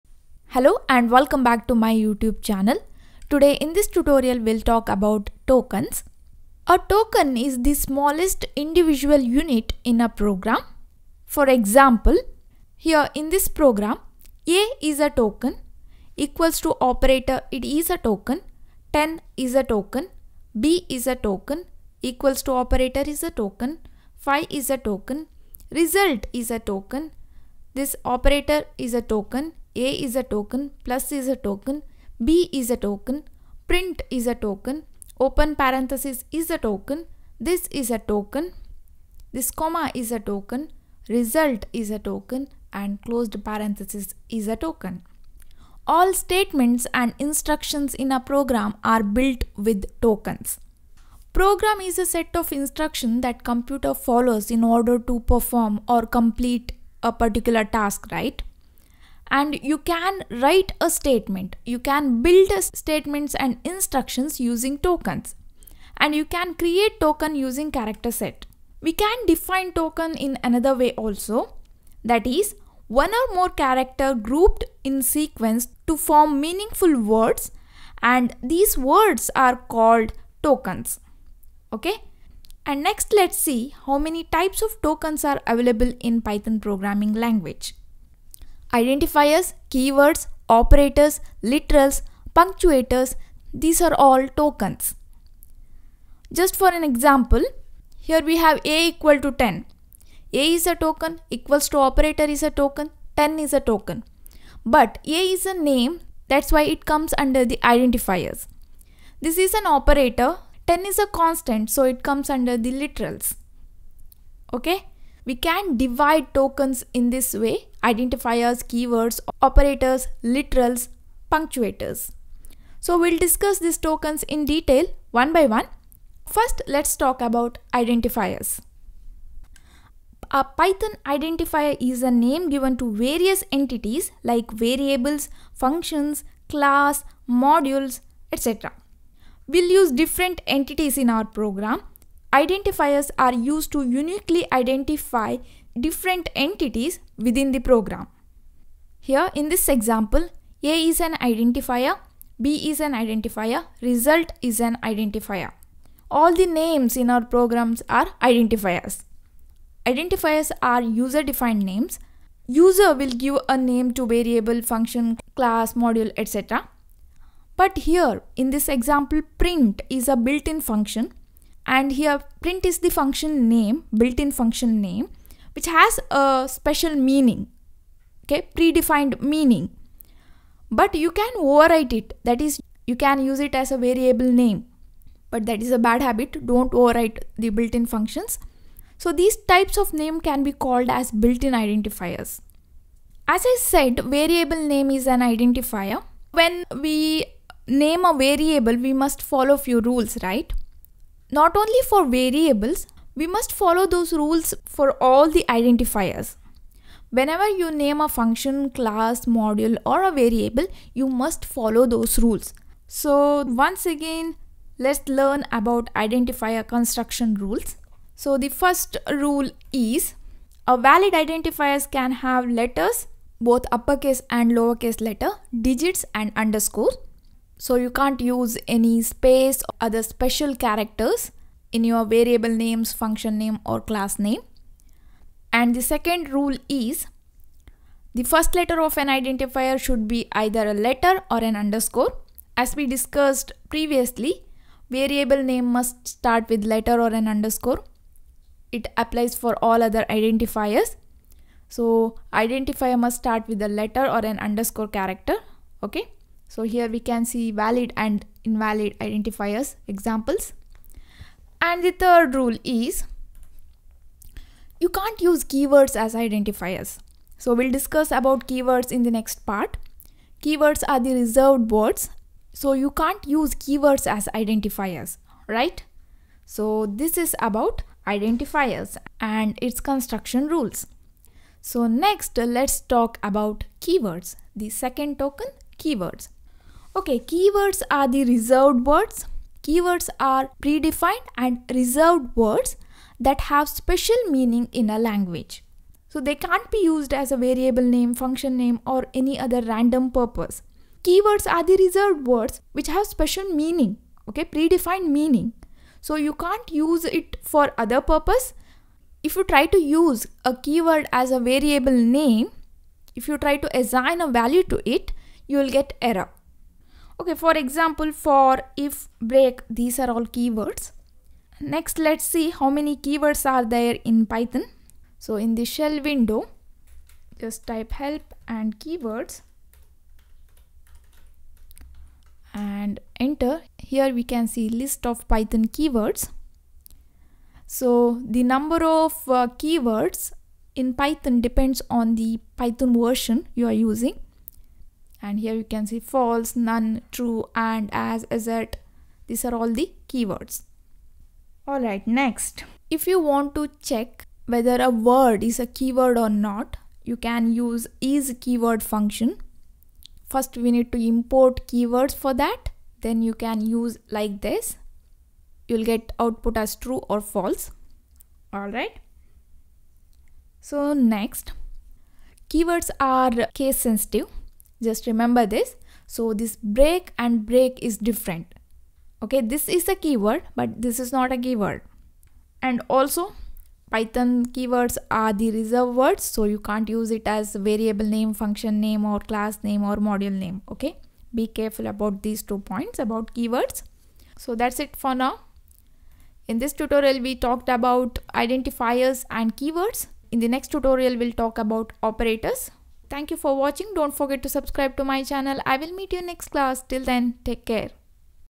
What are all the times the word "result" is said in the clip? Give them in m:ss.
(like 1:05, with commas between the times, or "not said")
0:25, 0:41, 2:33.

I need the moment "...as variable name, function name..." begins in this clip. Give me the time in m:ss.
6:27.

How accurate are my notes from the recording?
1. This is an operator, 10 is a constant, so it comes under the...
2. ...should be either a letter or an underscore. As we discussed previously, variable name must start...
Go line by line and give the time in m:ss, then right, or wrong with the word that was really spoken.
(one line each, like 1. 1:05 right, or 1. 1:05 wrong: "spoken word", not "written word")
1. 1:49 right
2. 3:59 right.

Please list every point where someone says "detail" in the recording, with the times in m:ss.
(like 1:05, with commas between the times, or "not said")
2:04.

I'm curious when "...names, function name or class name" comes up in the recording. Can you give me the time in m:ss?
3:52.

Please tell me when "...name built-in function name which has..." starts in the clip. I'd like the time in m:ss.
2:53.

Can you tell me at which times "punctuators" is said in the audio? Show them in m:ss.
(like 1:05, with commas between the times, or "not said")
1:32, 2:01.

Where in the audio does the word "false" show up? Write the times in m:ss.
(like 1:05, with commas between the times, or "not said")
5:45, 6:07.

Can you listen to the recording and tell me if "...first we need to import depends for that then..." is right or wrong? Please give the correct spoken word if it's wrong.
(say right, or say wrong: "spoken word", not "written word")
wrong: "keywords", not "depends".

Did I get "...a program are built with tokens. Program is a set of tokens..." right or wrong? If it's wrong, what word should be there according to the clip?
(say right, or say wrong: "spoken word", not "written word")
wrong: "instructions", not "tokens".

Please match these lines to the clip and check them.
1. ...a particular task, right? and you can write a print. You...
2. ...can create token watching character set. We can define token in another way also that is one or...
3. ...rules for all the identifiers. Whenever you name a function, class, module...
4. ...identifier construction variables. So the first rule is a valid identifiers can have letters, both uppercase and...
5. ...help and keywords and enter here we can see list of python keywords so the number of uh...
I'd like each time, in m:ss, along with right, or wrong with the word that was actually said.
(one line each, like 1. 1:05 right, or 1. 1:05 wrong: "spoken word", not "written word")
1. 0:57 wrong: "statement", not "print"
2. 1:06 wrong: "using", not "watching"
3. 3:24 right
4. 3:35 wrong: "rules", not "variables"
5. 5:28 right.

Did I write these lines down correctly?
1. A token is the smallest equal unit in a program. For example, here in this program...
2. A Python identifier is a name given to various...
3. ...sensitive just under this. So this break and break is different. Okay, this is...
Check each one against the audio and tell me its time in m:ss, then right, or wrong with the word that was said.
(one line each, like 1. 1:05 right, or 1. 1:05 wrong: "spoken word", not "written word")
1. 0:06 wrong: "individual", not "equal"
2. 2:10 right
3. 6:13 wrong: "remember", not "under".